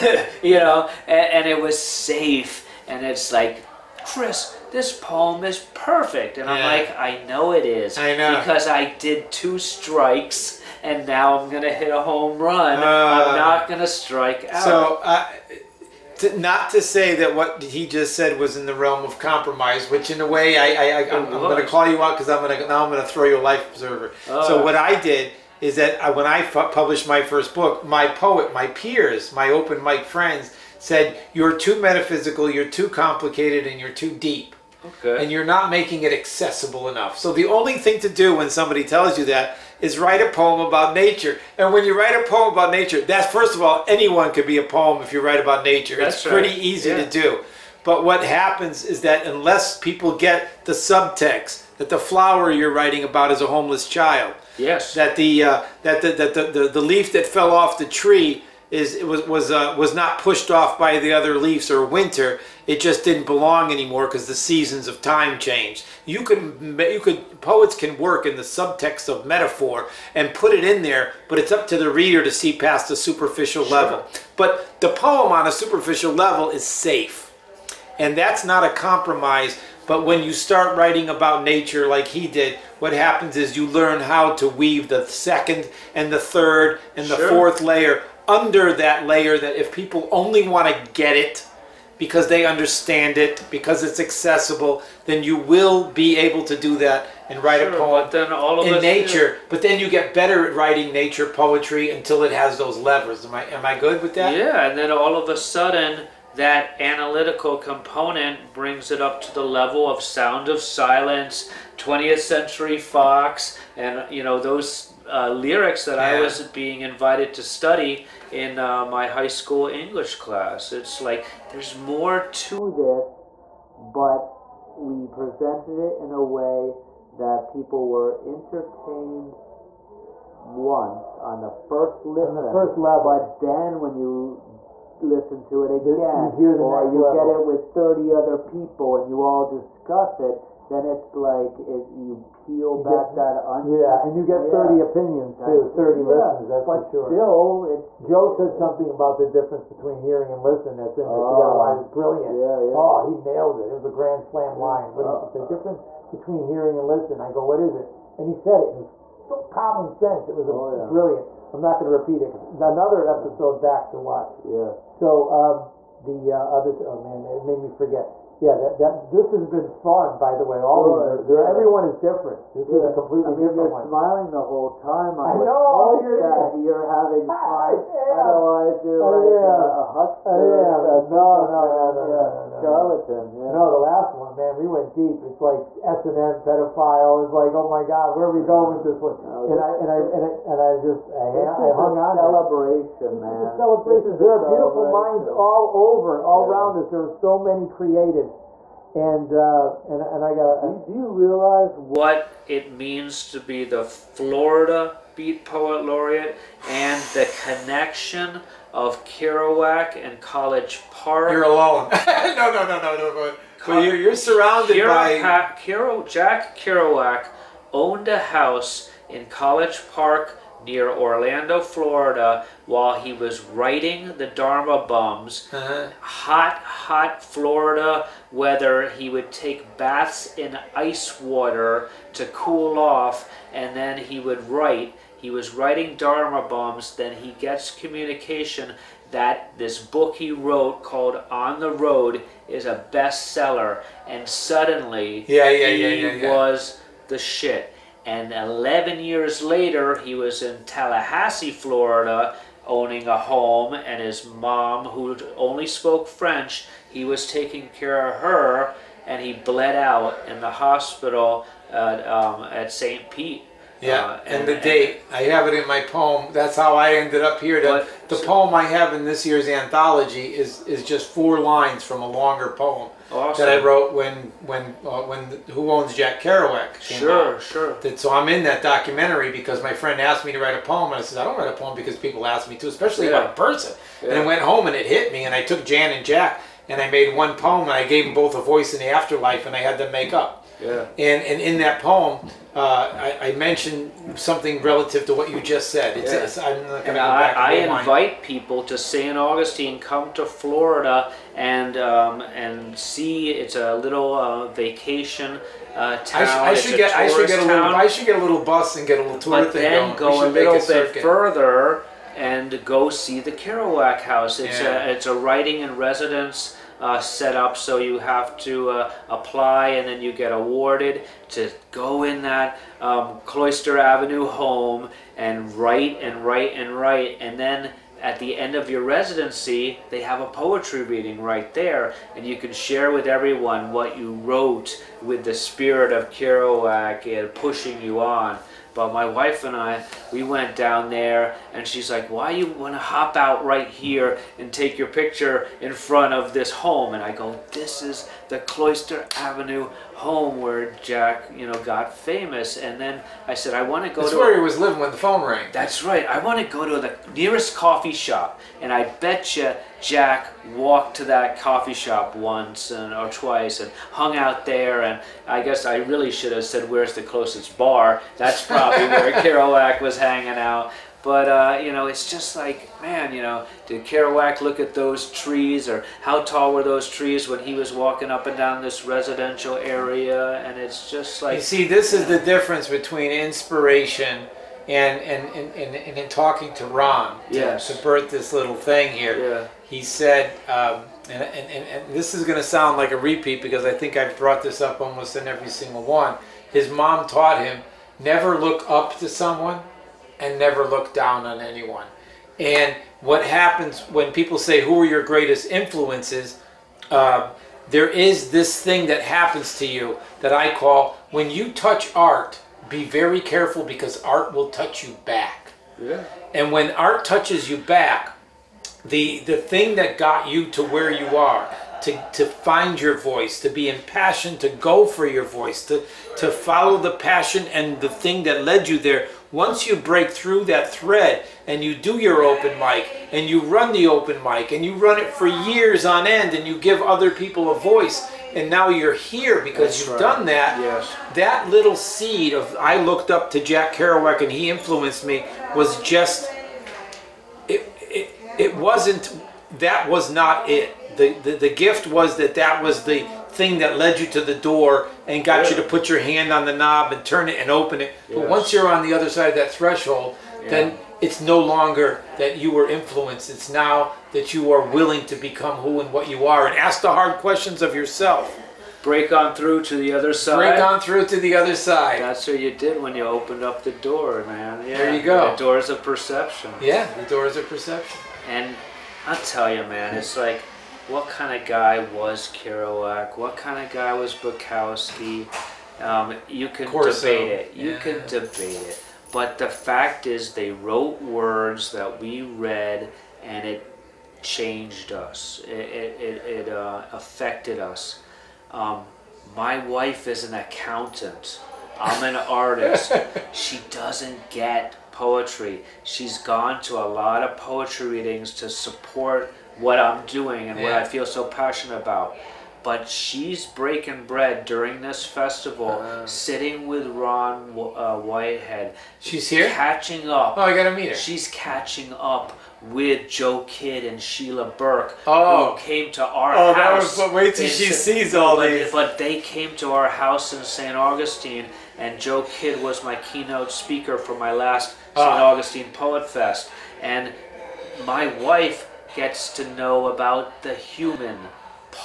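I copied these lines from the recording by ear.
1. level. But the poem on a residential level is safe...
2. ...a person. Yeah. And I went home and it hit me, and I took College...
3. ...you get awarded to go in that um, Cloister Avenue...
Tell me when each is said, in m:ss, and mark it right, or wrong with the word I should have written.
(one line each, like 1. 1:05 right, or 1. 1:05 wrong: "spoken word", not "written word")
1. 1:13 wrong: "superficial", not "residential"
2. 4:43 wrong: "Jan", not "College"
3. 5:20 right.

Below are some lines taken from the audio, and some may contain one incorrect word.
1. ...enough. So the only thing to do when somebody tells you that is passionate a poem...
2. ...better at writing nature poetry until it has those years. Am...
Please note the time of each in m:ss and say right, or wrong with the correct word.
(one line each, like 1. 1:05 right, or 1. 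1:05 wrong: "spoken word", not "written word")
1. 0:36 wrong: "write", not "passionate"
2. 1:40 wrong: "levers", not "years".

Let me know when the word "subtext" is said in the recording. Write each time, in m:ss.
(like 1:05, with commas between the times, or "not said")
0:50, 1:08.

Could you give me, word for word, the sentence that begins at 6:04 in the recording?
And I guess I really should have said, Where's the closest bar?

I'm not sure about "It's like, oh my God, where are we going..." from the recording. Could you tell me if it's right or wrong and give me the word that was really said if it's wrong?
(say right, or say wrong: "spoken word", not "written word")
right.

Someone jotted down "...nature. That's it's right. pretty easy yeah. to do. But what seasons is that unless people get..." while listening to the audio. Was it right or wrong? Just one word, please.
wrong.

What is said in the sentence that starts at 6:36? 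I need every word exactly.
His mom taught him never look up to someone, and never look down on anyone.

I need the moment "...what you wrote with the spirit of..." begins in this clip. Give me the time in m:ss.
5:33.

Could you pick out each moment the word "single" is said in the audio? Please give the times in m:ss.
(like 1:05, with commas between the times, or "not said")
6:35.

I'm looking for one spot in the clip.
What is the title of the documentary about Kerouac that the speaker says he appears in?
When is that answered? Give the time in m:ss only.
4:35.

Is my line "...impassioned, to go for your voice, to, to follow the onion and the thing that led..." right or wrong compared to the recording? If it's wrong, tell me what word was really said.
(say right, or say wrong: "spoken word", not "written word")
wrong: "passion", not "onion".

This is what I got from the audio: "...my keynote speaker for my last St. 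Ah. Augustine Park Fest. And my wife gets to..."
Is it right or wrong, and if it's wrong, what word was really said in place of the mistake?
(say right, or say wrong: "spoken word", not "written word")
wrong: "Poet", not "Park".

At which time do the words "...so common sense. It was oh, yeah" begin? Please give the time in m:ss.
2:39.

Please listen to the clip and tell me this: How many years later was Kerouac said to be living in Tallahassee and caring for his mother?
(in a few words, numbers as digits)
11.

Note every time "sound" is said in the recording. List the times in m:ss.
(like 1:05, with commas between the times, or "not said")
1:49, 6:32.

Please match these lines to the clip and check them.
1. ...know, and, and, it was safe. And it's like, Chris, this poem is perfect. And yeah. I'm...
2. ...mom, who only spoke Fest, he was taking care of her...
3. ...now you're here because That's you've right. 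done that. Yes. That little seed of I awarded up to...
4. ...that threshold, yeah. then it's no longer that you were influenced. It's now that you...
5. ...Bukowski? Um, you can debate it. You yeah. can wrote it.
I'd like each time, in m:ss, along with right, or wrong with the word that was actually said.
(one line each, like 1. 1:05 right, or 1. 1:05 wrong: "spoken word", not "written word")
1. 0:00 right
2. 4:14 wrong: "French", not "Fest"
3. 7:18 wrong: "looked", not "awarded"
4. 7:39 right
5. 8:04 wrong: "debate", not "wrote".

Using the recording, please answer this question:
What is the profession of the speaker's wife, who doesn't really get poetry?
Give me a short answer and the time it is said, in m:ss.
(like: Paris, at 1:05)
Accountant, at 8:20.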